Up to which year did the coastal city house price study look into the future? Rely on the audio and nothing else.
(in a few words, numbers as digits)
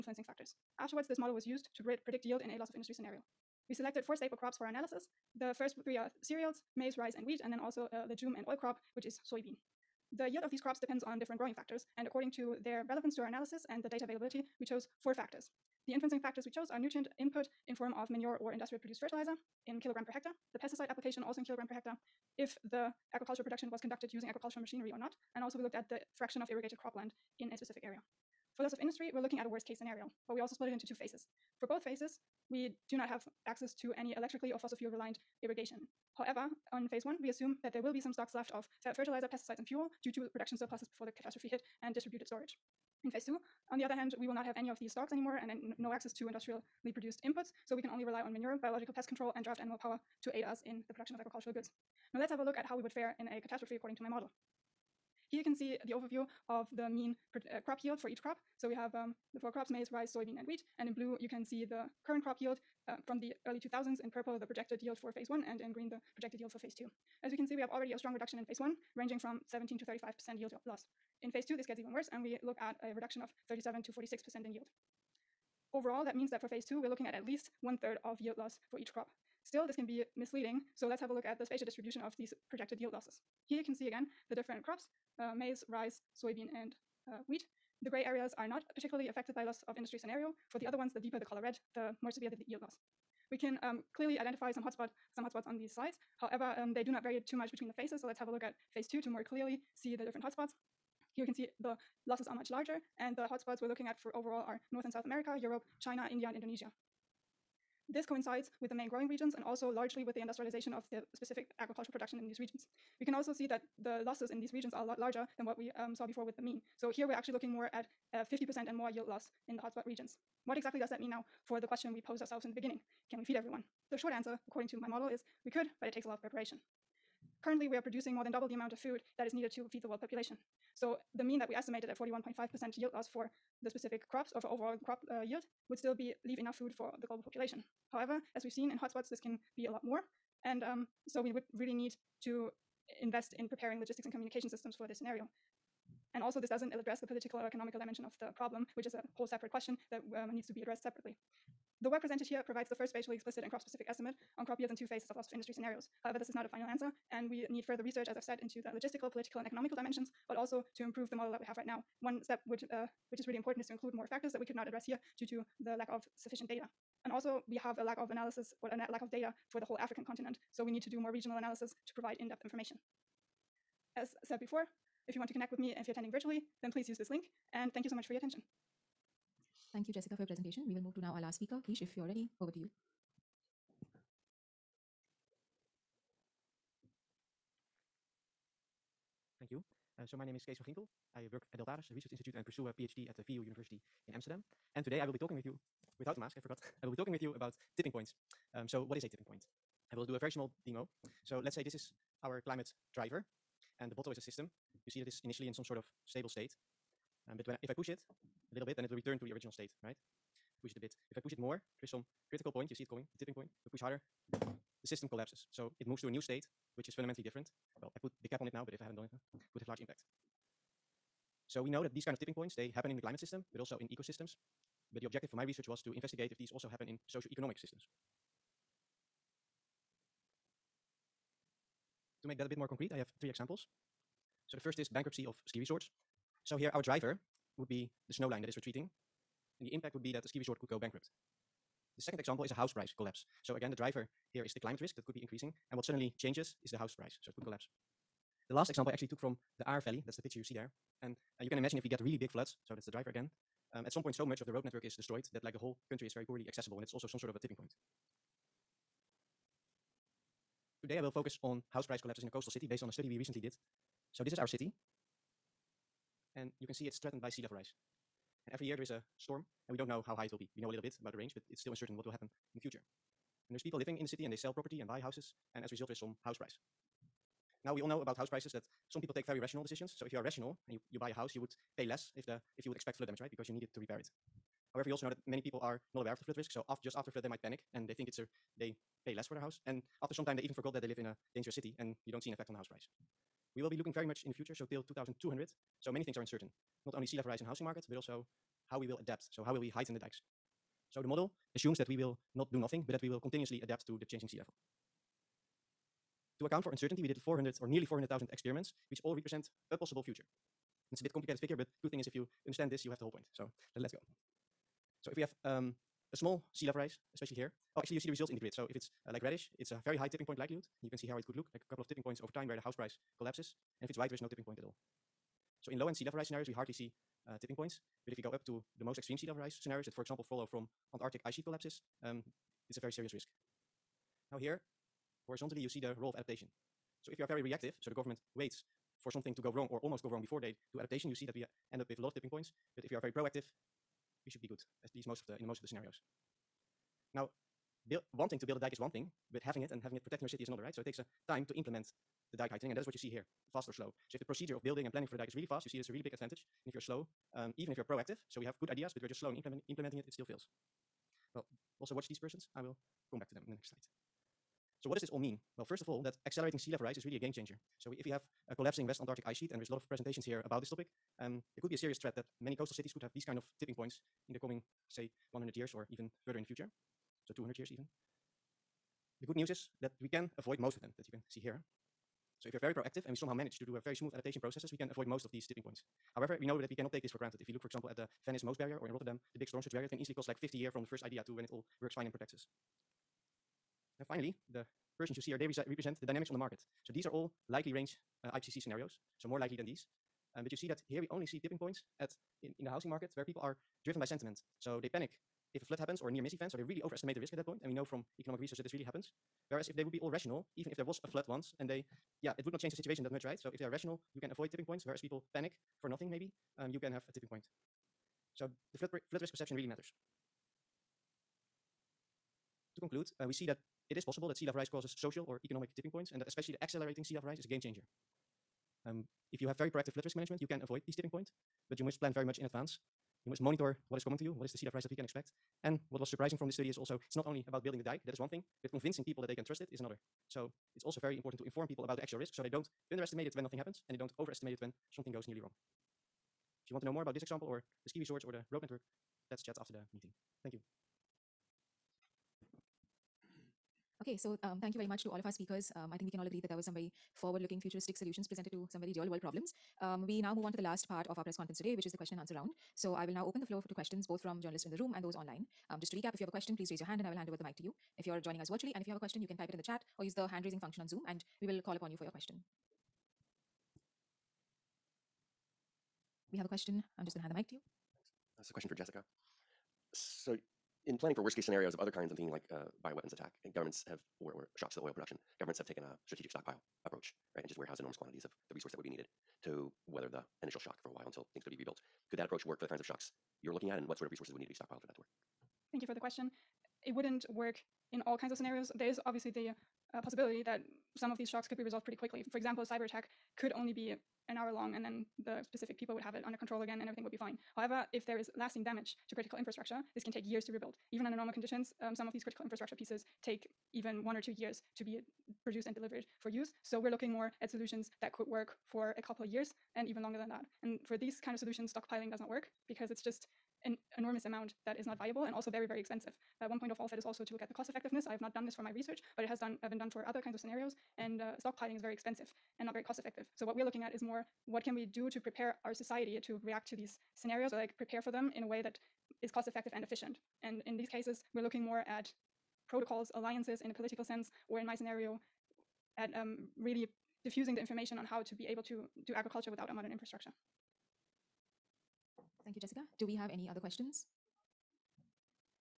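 2200.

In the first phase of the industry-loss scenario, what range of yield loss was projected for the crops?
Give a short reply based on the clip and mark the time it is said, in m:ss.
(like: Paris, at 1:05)
17 to 35%, at 1:09.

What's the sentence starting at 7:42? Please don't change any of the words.
So I will now open the floor to questions, both from journalists in the room and those online.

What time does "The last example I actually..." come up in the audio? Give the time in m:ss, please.
4:08.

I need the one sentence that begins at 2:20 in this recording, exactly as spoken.
And um, so we would really need to invest in preparing logistics and communication systems for this scenario.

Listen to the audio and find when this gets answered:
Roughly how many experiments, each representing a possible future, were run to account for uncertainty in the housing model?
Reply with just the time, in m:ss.
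5:07.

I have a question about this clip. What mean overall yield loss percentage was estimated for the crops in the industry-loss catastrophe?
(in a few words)
41.5%.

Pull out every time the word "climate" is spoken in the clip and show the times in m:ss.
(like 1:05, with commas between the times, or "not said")
3:22, 3:43, 4:04.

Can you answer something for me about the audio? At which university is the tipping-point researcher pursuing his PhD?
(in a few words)
VU University.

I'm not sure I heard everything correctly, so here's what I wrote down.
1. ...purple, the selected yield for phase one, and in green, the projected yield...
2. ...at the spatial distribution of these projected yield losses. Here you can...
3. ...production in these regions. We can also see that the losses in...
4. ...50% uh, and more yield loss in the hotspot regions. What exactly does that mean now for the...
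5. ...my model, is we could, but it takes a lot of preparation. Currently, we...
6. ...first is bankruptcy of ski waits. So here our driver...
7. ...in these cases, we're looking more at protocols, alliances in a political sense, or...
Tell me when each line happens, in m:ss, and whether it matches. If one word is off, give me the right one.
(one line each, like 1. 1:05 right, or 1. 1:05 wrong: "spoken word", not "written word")
1. 1:04 wrong: "projected", not "selected"
2. 1:21 right
3. 1:51 right
4. 1:58 right
5. 2:04 right
6. 3:54 wrong: "resorts", not "waits"
7. 9:00 right.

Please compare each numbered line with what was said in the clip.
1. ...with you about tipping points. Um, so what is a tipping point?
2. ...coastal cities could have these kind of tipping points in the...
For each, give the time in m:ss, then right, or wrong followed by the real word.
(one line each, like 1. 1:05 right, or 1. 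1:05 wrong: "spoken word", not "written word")
1. 3:17 right
2. 6:12 right.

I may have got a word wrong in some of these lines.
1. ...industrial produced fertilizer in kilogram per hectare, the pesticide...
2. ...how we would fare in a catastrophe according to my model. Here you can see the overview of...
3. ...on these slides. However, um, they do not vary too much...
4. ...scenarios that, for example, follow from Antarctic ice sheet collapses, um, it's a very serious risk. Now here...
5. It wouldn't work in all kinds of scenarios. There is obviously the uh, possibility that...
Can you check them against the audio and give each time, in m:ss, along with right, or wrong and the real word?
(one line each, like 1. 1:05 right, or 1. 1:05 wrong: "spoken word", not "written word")
1. 0:18 right
2. 0:52 right
3. 1:35 right
4. 5:29 right
5. 8:16 right.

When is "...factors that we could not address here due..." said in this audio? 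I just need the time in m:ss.
2:44.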